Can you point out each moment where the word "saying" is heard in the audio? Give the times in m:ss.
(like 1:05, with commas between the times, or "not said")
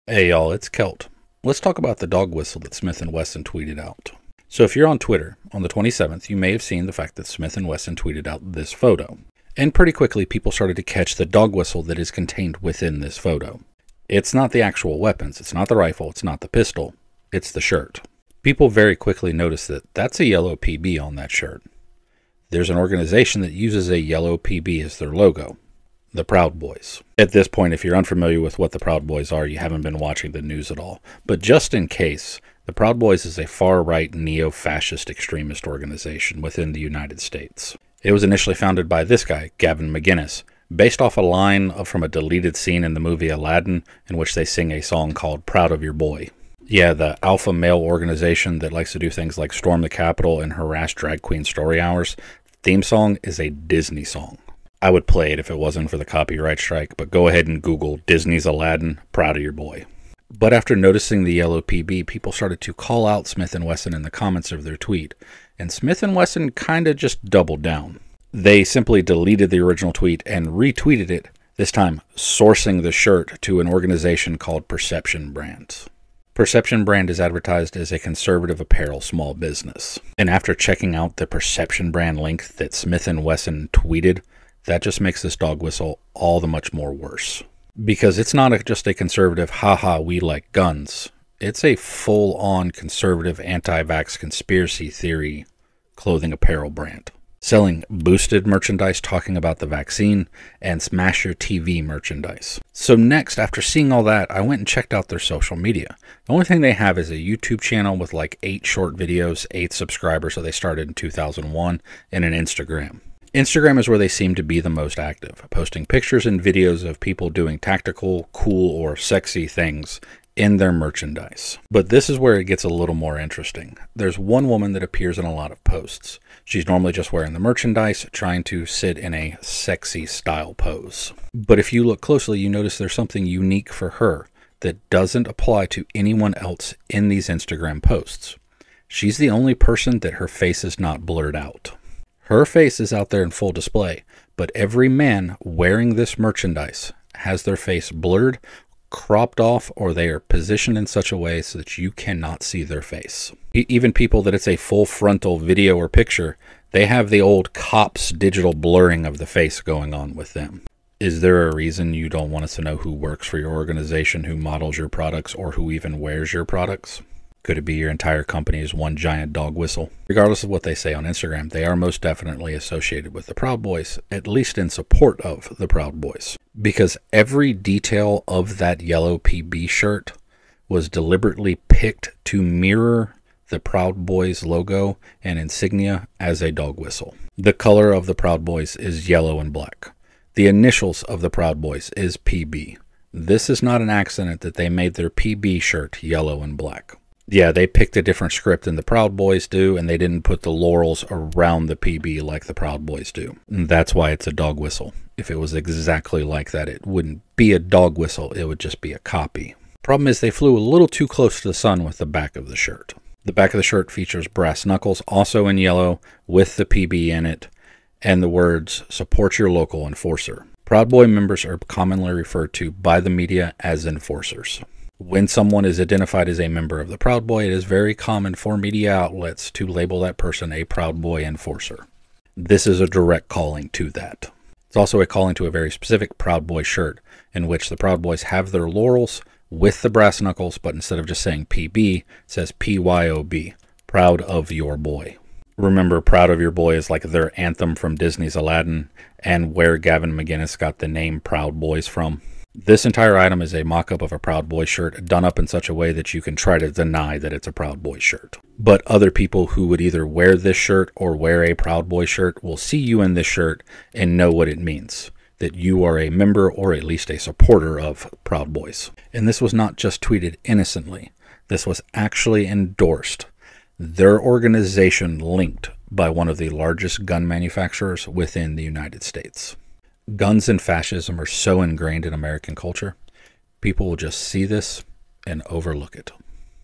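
4:01.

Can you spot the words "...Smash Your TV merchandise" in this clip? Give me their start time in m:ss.
1:40.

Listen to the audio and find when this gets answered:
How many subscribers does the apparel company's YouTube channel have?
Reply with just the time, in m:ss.
1:49.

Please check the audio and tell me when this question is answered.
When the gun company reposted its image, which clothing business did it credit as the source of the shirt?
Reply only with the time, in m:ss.
1:14.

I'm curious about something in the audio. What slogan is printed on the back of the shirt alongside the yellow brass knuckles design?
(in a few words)
Support your local enforcer.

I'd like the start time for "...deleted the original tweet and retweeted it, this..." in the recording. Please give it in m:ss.
1:09.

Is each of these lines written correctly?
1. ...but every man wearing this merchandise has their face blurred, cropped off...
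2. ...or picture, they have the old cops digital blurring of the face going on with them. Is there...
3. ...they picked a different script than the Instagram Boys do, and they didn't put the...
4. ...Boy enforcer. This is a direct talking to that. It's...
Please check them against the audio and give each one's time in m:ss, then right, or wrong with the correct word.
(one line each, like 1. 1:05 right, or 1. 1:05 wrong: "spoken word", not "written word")
1. 2:24 right
2. 2:35 right
3. 3:17 wrong: "Proud", not "Instagram"
4. 3:51 wrong: "calling", not "talking".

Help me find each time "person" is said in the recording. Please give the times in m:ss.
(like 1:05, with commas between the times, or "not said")
2:19, 3:50.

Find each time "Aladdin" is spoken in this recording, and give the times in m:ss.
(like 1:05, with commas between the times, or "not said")
0:43, 0:58, 4:08.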